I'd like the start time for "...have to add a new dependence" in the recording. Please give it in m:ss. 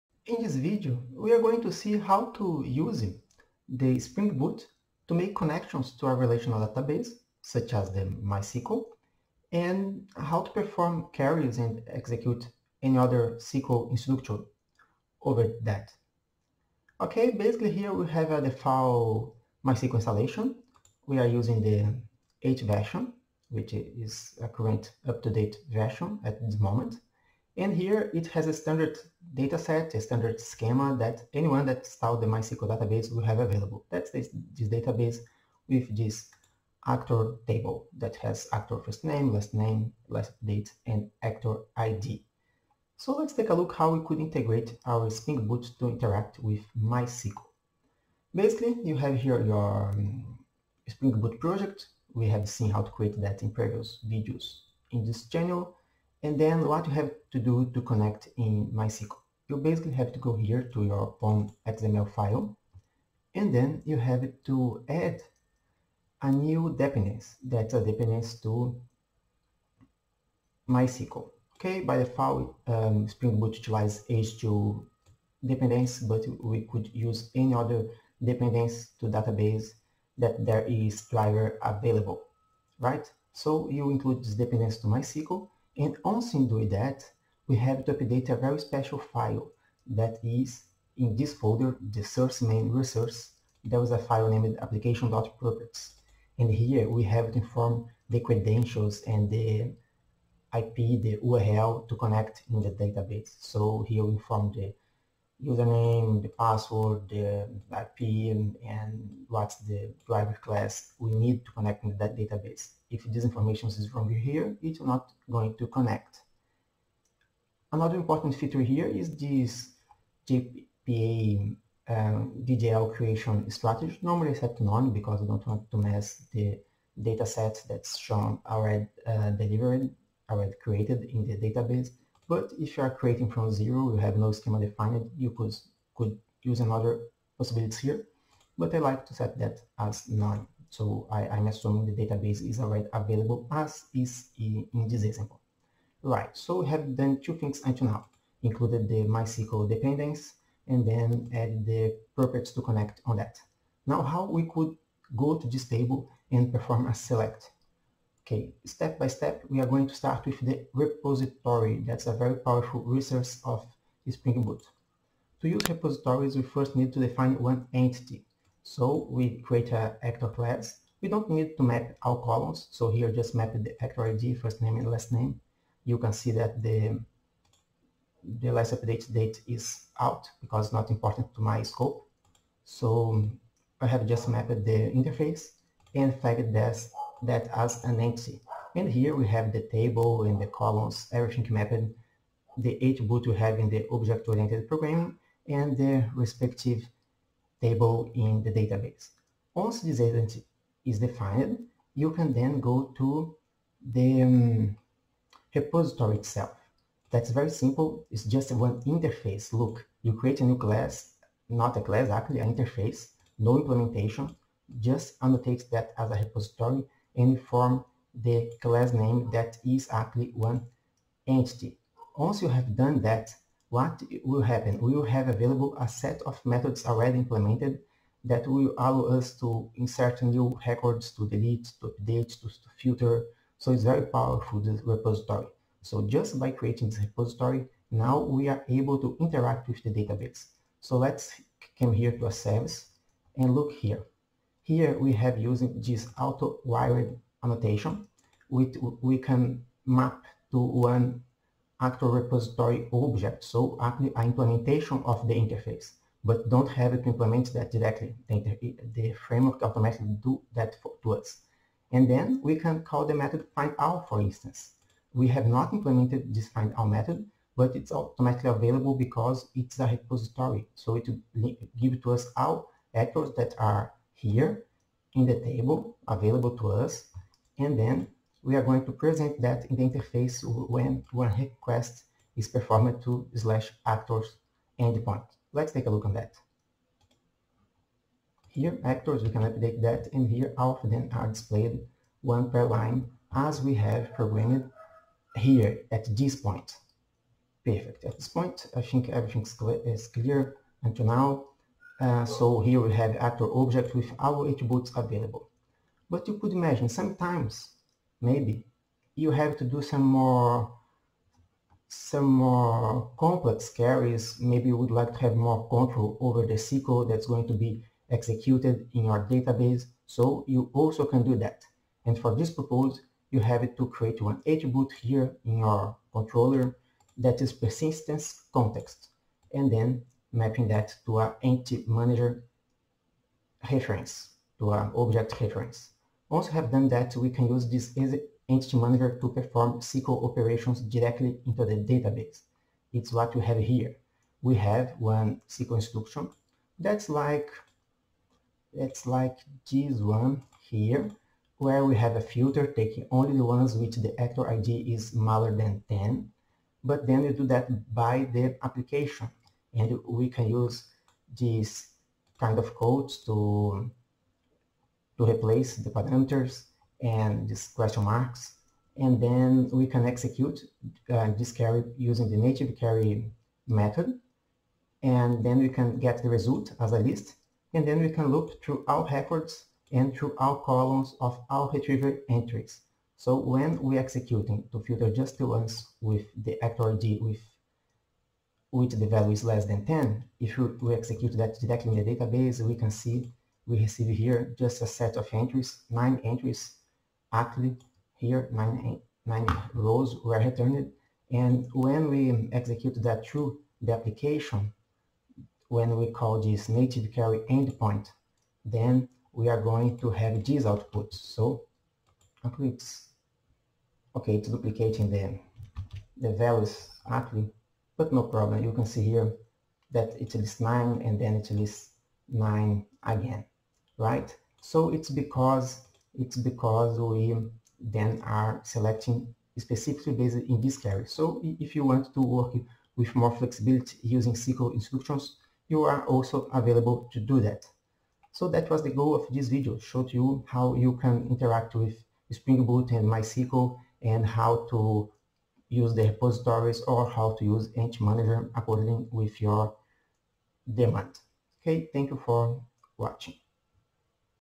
1:03.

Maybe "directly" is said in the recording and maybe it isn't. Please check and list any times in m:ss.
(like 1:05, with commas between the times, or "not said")
4:17, 5:40, 6:31.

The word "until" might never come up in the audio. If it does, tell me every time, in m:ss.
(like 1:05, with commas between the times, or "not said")
2:27, 5:00.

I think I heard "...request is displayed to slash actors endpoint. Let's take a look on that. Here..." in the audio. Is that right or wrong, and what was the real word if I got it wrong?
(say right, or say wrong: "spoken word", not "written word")
wrong: "performed", not "displayed".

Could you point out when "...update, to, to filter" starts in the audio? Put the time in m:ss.
3:52.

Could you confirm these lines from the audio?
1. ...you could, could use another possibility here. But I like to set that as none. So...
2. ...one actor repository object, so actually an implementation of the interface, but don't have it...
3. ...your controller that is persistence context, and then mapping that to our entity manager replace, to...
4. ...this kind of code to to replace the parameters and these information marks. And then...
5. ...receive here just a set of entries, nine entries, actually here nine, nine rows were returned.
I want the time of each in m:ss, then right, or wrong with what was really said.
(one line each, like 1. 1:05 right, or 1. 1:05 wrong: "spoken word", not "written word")
1. 2:15 right
2. 4:10 right
3. 5:25 wrong: "reference", not "replace"
4. 6:01 wrong: "question", not "information"
5. 6:33 right.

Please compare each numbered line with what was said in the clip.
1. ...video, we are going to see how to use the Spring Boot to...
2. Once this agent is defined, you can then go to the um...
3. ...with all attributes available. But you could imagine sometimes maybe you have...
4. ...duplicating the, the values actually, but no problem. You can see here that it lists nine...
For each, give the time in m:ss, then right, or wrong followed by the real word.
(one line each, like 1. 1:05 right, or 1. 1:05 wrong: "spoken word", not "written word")
1. 0:00 right
2. 3:19 right
3. 5:03 right
4. 6:54 right.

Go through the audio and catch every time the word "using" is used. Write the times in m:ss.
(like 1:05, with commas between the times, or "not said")
0:21, 4:05, 6:11, 7:14.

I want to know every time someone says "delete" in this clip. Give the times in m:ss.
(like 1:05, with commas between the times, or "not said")
3:51.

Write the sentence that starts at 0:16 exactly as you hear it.
Okay, basically here we have a uh, default MySQL installation.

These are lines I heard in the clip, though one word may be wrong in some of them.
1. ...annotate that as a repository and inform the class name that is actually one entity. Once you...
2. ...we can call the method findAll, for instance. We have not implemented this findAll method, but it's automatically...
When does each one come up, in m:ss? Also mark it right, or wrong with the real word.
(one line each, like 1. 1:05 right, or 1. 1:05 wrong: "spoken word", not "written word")
1. 3:35 right
2. 4:22 right.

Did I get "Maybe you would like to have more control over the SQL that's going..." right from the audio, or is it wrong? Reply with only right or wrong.
right.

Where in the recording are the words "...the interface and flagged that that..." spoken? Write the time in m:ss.
3:04.